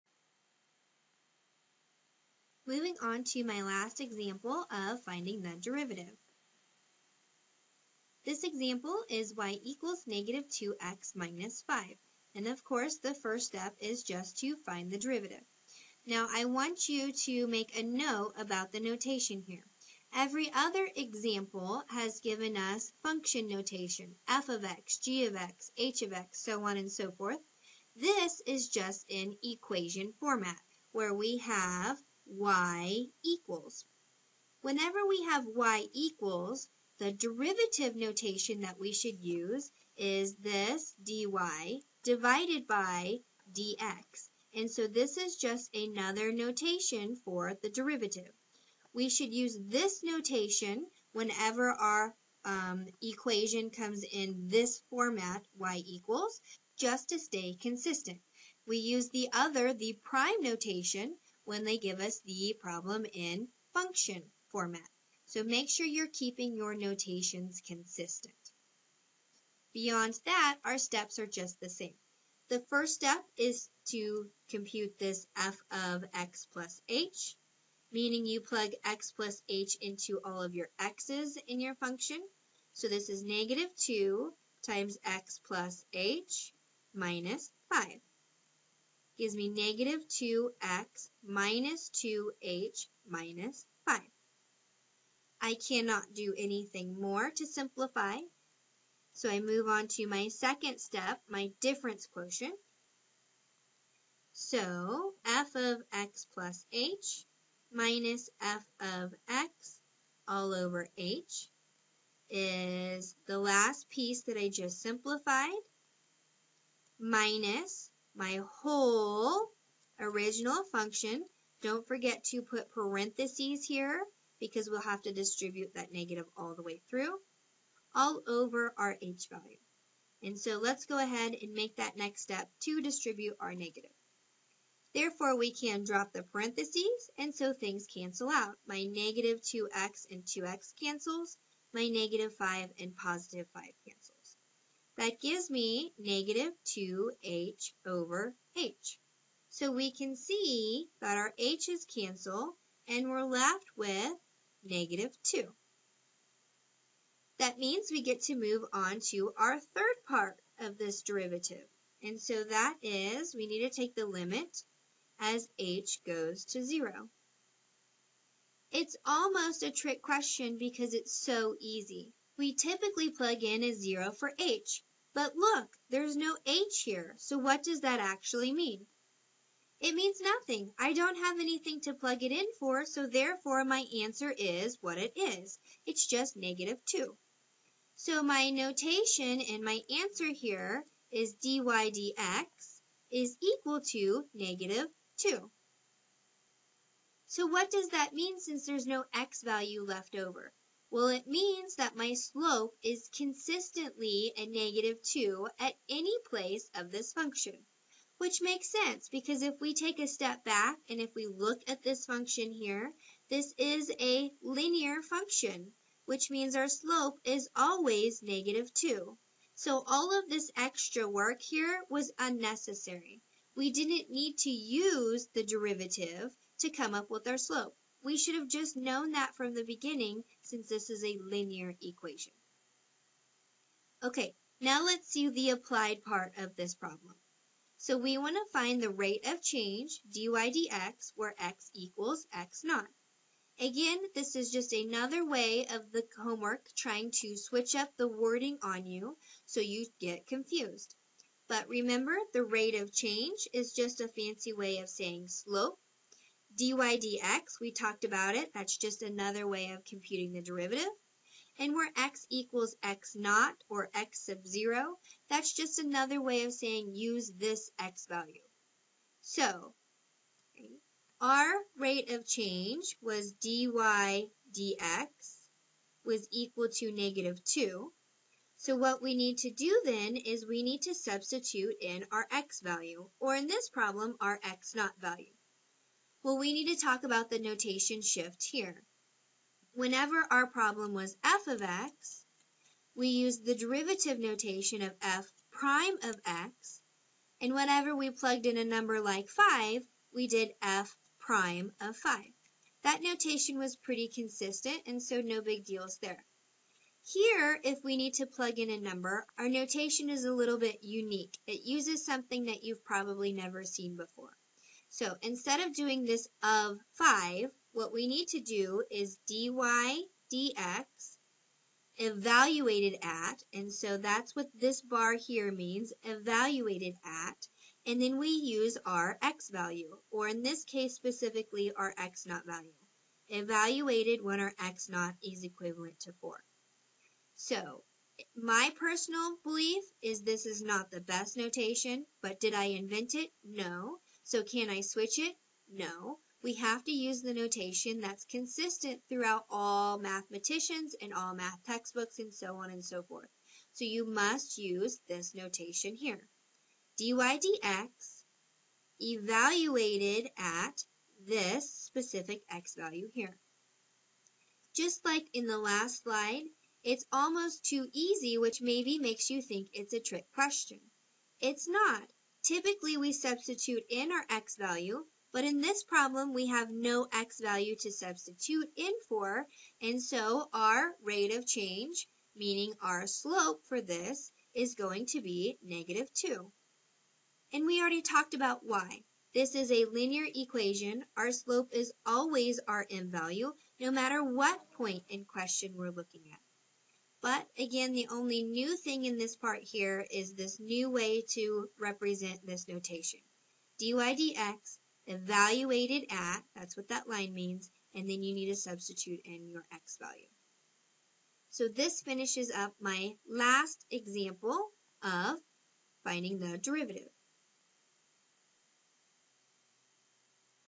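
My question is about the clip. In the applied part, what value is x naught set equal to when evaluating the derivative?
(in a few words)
4.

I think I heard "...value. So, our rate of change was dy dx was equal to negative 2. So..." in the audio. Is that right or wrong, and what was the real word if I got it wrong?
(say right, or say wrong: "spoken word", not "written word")
right.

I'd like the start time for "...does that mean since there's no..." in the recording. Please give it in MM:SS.
03:17.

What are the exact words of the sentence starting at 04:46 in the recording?
Well, we need to talk about the notation shift here.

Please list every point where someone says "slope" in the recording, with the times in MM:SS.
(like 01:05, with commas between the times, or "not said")
03:22, 03:36, 03:47, 04:15, 06:23, 06:31.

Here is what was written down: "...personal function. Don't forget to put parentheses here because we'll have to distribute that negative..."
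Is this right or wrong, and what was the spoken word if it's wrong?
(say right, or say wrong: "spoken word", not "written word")
wrong: "original", not "personal".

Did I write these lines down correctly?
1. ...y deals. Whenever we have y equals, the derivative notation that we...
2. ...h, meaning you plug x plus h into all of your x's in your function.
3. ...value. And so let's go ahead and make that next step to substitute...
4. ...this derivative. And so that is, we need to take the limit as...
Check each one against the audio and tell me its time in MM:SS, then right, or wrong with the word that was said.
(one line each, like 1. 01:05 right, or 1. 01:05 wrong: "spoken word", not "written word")
1. 00:32 wrong: "equals", not "deals"
2. 01:16 right
3. 02:09 wrong: "distribute", not "substitute"
4. 02:40 right.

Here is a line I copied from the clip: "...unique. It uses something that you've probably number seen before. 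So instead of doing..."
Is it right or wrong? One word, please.
wrong.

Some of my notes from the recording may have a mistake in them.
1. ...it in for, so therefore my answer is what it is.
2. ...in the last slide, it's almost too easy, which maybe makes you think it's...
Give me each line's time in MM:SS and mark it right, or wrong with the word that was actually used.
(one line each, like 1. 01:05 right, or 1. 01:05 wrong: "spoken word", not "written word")
1. 03:02 right
2. 06:05 right.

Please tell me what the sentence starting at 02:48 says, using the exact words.
It's almost a trick question because it's so easy.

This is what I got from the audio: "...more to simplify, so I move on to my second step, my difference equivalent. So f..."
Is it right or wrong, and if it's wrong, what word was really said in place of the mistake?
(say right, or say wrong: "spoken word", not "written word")
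wrong: "quotient", not "equivalent".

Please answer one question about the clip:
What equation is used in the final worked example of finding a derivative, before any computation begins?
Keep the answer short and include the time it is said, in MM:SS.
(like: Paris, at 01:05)
y = -2x - 5, at 00:09.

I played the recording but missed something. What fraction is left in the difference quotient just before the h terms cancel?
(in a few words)
-2h over h.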